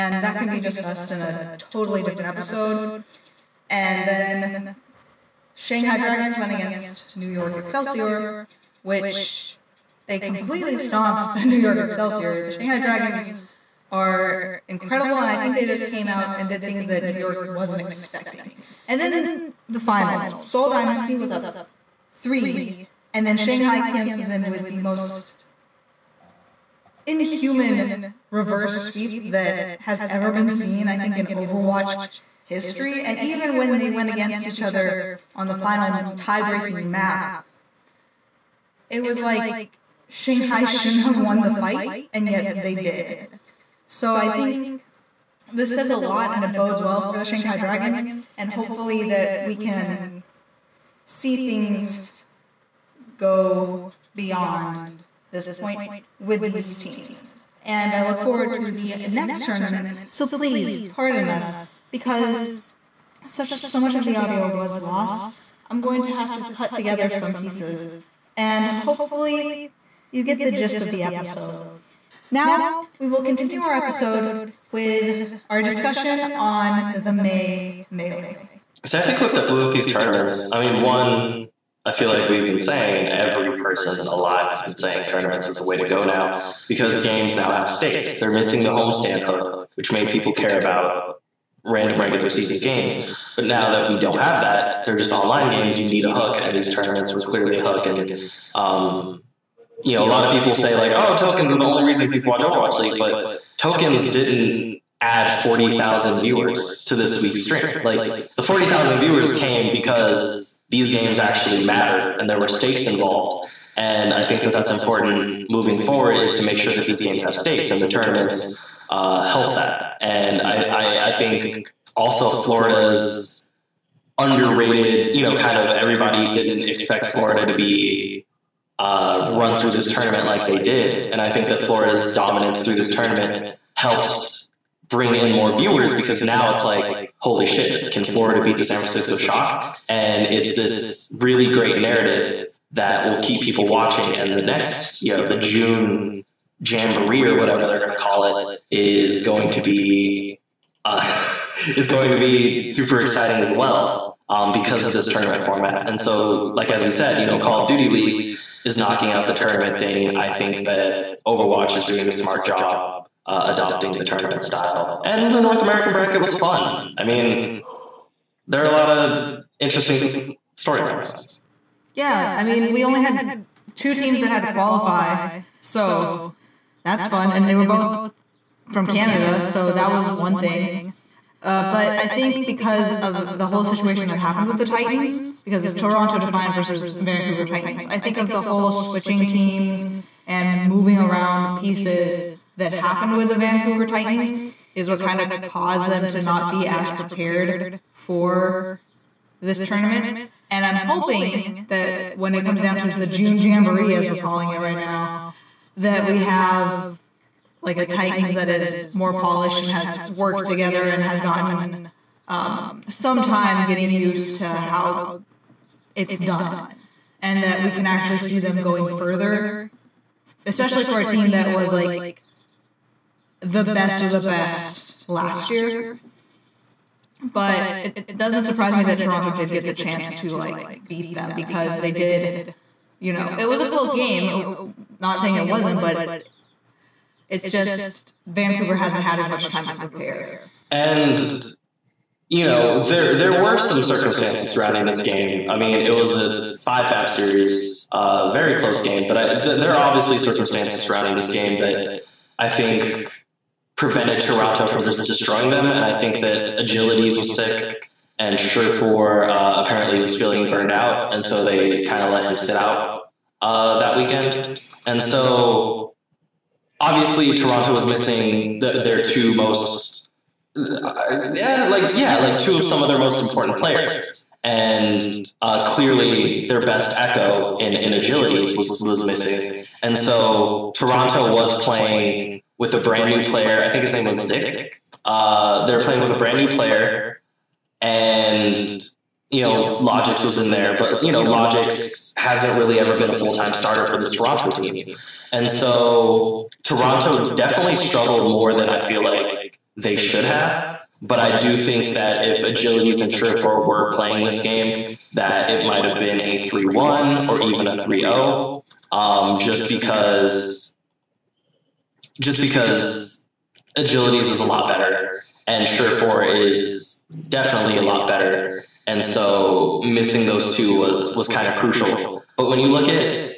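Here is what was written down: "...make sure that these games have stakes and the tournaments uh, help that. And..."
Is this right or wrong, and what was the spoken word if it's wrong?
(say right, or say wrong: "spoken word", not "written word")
right.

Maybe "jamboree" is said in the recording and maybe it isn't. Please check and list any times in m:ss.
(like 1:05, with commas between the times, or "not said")
2:26, 3:23.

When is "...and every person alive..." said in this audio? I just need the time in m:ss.
1:22.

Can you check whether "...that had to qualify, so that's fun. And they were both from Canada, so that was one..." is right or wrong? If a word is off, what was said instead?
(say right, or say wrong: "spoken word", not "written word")
right.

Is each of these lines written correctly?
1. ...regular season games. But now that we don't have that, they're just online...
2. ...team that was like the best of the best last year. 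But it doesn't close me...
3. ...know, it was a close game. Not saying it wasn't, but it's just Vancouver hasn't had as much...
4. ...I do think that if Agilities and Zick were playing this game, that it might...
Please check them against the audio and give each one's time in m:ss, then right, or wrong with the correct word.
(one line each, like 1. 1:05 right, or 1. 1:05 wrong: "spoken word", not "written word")
1. 1:32 right
2. 3:41 wrong: "surprise", not "close"
3. 3:53 right
4. 5:01 wrong: "Surefour", not "Zick".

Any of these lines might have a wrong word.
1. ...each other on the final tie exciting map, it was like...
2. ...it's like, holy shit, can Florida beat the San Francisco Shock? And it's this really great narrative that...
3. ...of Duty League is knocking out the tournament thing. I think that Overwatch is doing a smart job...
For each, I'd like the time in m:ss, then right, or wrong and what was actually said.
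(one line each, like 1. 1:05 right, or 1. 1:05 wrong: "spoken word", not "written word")
1. 0:34 wrong: "breaking", not "exciting"
2. 2:16 right
3. 2:37 right.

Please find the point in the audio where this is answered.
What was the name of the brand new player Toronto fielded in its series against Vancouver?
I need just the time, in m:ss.
4:44.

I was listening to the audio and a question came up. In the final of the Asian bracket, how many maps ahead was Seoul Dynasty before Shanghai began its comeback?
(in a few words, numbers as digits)
3.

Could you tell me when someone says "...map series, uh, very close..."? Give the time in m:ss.
4:06.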